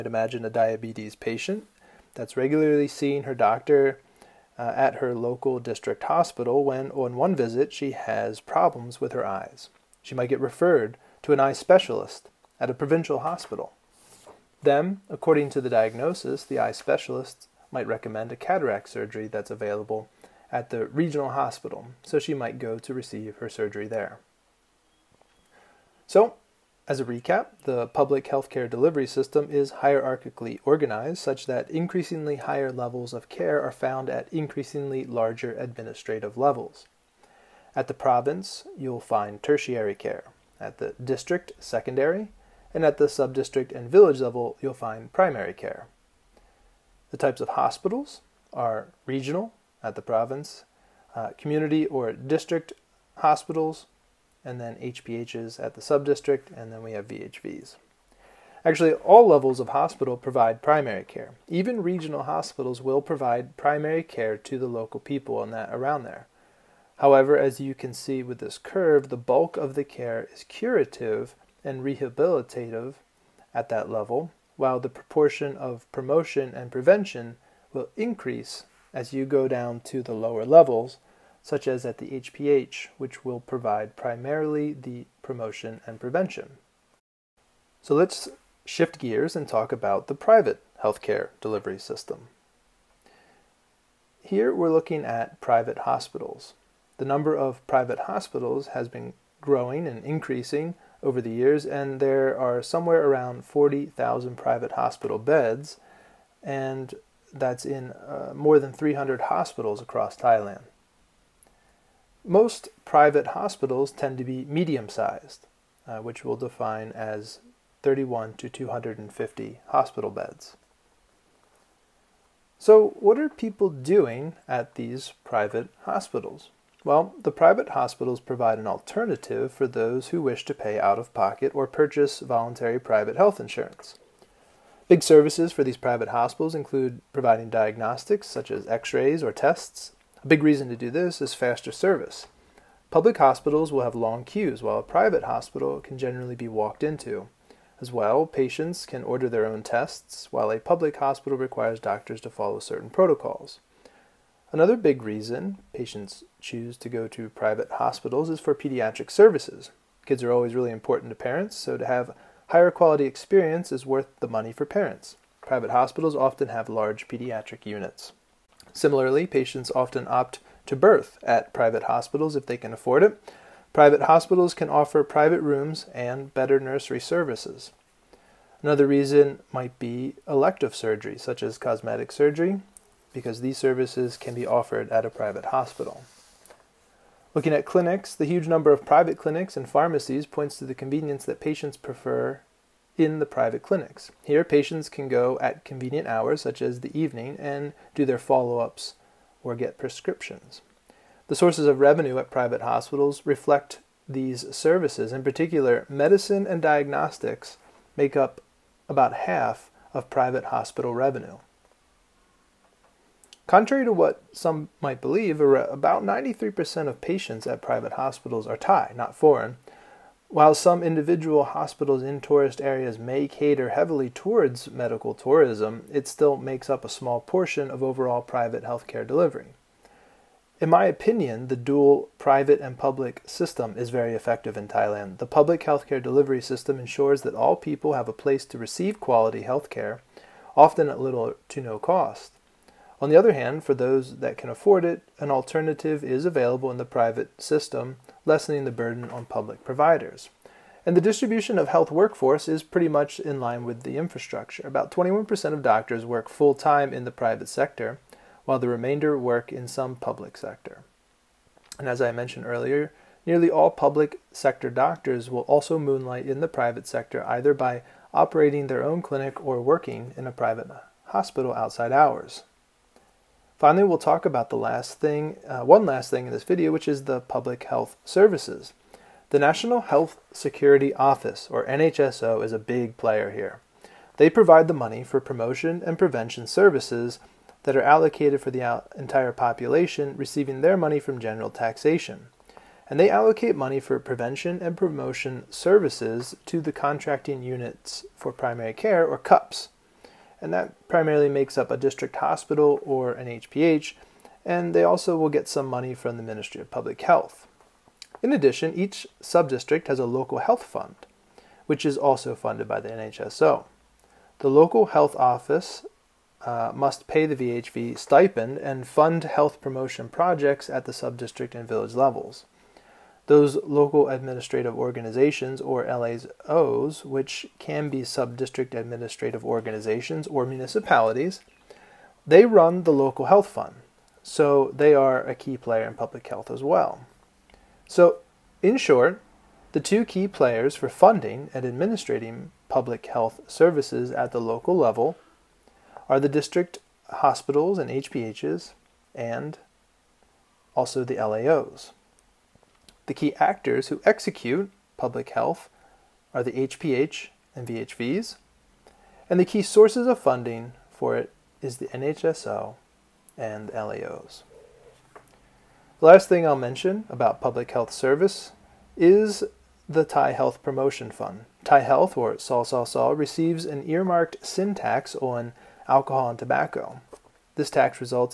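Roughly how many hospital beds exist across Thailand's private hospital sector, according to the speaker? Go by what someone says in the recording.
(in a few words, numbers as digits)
40,000.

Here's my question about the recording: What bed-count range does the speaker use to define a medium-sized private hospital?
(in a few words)
31 to 250.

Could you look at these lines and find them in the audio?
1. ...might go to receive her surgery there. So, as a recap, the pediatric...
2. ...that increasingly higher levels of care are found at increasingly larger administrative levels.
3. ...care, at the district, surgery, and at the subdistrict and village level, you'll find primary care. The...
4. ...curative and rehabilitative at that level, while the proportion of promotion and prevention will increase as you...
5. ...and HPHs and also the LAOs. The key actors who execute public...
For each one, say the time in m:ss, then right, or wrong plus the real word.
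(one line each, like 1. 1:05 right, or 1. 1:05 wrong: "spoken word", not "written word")
1. 0:22 wrong: "public", not "pediatric"
2. 0:31 right
3. 0:39 wrong: "secondary", not "surgery"
4. 1:10 right
5. 5:47 right.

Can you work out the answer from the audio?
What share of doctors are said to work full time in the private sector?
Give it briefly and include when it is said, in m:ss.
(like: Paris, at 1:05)
21%, at 4:14.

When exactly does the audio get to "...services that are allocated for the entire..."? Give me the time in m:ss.
4:46.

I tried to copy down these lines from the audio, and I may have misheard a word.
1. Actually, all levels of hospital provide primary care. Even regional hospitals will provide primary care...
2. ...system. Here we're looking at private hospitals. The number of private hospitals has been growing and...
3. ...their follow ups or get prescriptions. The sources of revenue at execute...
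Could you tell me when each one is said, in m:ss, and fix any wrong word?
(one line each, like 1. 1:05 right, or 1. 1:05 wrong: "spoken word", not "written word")
1. 0:58 right
2. 1:31 right
3. 3:18 wrong: "private", not "execute".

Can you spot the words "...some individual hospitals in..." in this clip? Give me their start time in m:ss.
3:40.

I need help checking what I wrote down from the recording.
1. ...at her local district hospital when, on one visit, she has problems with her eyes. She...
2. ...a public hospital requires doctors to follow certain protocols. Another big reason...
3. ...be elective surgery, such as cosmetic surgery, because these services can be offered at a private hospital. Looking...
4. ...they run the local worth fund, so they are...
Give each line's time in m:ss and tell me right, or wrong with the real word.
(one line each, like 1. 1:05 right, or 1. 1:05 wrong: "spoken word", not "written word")
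1. 0:04 right
2. 2:30 right
3. 2:59 right
4. 5:32 wrong: "health", not "worth".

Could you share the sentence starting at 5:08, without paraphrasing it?
In addition, each subdistrict has a local health fund, which is also funded by the NHSO.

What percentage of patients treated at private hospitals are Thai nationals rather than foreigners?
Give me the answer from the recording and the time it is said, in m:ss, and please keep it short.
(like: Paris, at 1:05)
93%, at 3:36.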